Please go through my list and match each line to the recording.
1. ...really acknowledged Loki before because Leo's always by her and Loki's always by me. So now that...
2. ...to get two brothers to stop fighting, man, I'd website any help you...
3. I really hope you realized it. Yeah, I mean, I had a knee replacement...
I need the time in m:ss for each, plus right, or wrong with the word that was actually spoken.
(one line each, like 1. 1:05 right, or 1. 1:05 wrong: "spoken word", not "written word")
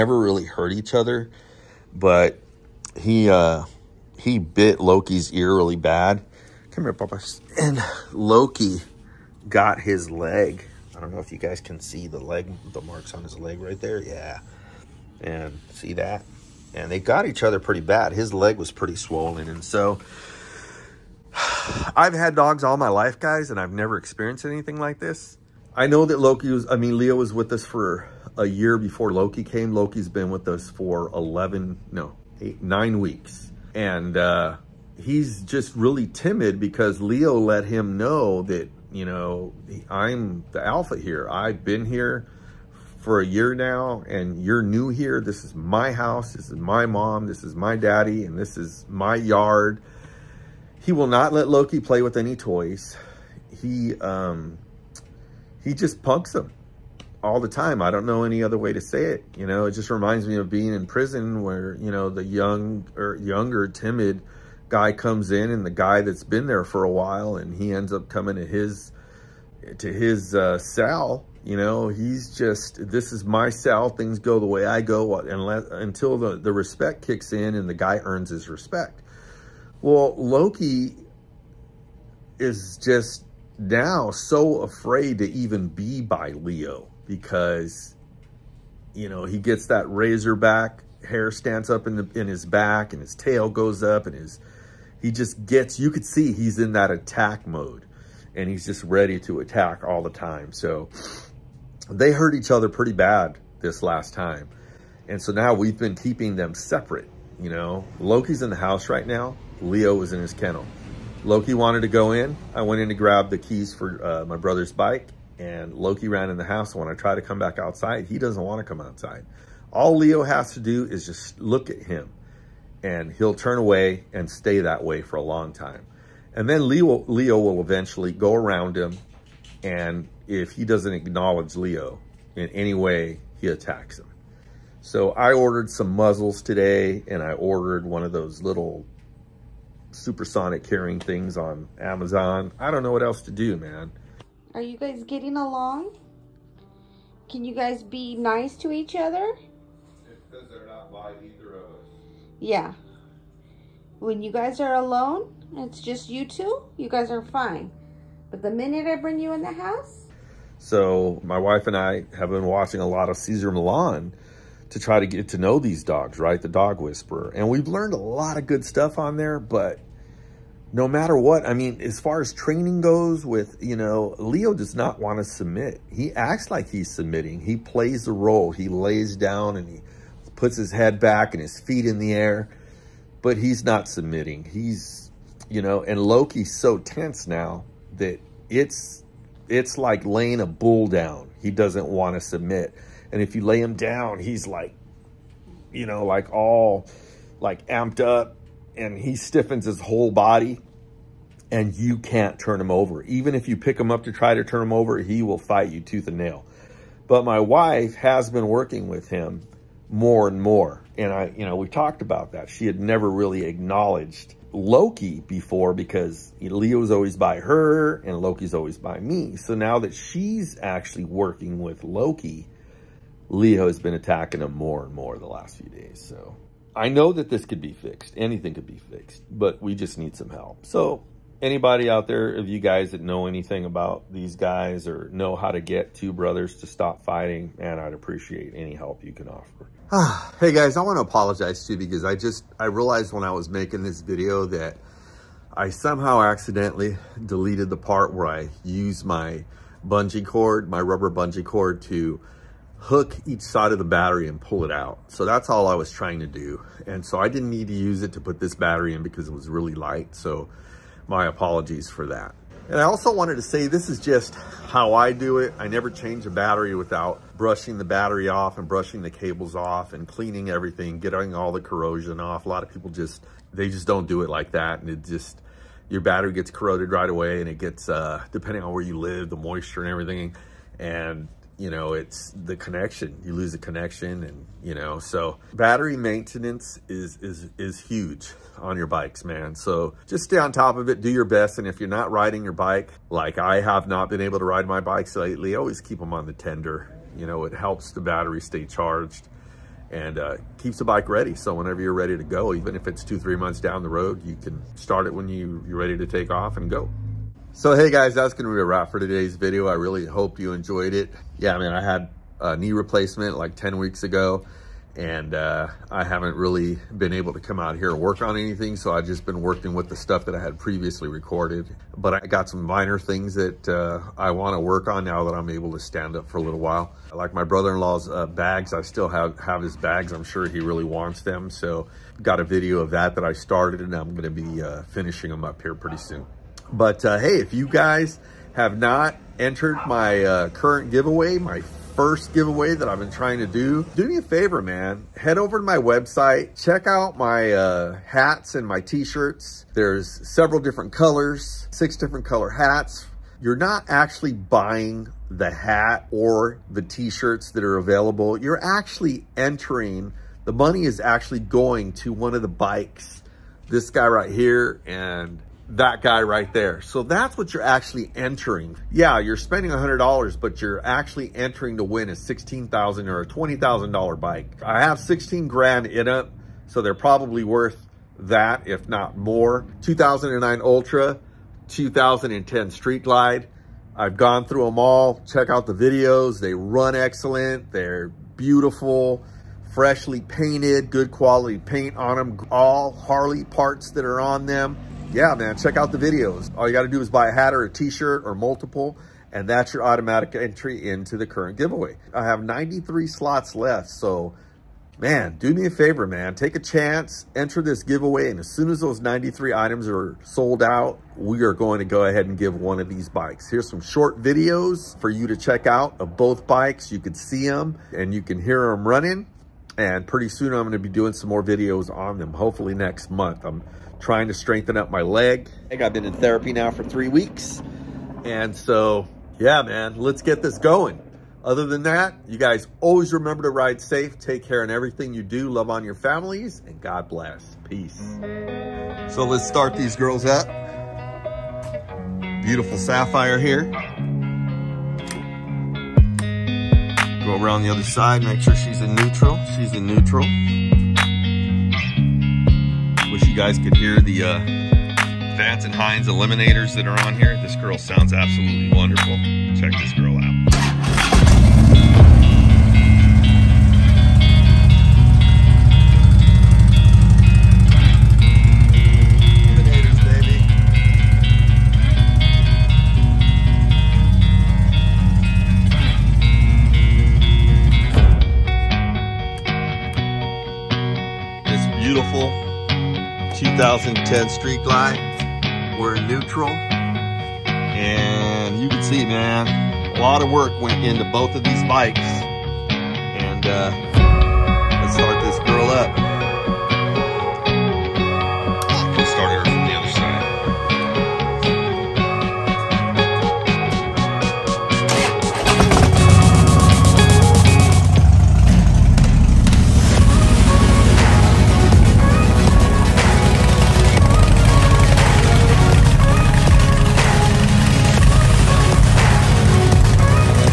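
1. 3:33 right
2. 3:55 wrong: "appreciate", not "website"
3. 5:09 wrong: "enjoyed", not "realized".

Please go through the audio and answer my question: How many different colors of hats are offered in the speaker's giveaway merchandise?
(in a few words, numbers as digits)
6.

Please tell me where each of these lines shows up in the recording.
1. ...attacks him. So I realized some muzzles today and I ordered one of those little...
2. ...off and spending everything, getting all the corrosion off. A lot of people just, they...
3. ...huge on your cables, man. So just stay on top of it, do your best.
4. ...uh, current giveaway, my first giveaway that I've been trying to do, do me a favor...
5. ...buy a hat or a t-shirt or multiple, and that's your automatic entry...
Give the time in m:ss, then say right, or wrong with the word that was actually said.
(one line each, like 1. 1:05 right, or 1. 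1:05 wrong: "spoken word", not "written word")
1. 2:13 wrong: "ordered", not "realized"
2. 4:29 wrong: "cleaning", not "spending"
3. 4:47 wrong: "bikes", not "cables"
4. 5:40 right
5. 6:37 right.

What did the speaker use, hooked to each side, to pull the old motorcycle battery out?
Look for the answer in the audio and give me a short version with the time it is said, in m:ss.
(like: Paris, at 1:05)
rubber bungee cord, at 4:10.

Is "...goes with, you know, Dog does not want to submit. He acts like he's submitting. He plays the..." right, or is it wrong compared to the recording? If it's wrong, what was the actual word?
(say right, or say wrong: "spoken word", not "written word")
wrong: "Leo", not "Dog".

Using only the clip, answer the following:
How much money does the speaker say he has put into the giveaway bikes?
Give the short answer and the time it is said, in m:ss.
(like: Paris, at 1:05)
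16 grand, at 6:14.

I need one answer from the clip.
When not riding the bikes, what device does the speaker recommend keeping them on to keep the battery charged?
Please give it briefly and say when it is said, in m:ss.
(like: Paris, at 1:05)
the tender, at 4:56.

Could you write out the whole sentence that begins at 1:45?
And so now we've been keeping them separate, you know.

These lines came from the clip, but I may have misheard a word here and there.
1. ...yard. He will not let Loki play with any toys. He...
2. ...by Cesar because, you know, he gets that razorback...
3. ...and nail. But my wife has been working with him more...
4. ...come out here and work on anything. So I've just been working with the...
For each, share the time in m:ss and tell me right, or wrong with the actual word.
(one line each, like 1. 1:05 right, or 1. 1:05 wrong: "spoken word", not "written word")
1. 0:49 right
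2. 1:26 wrong: "Leo", not "Cesar"
3. 3:26 right
4. 5:17 right.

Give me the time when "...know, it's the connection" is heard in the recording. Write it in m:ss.
4:41.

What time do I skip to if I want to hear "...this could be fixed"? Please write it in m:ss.
3:47.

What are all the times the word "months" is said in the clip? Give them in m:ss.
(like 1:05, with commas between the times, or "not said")
5:03, 7:03.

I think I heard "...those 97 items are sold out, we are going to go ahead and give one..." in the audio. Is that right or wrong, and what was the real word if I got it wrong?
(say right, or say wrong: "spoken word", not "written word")
wrong: "93", not "97".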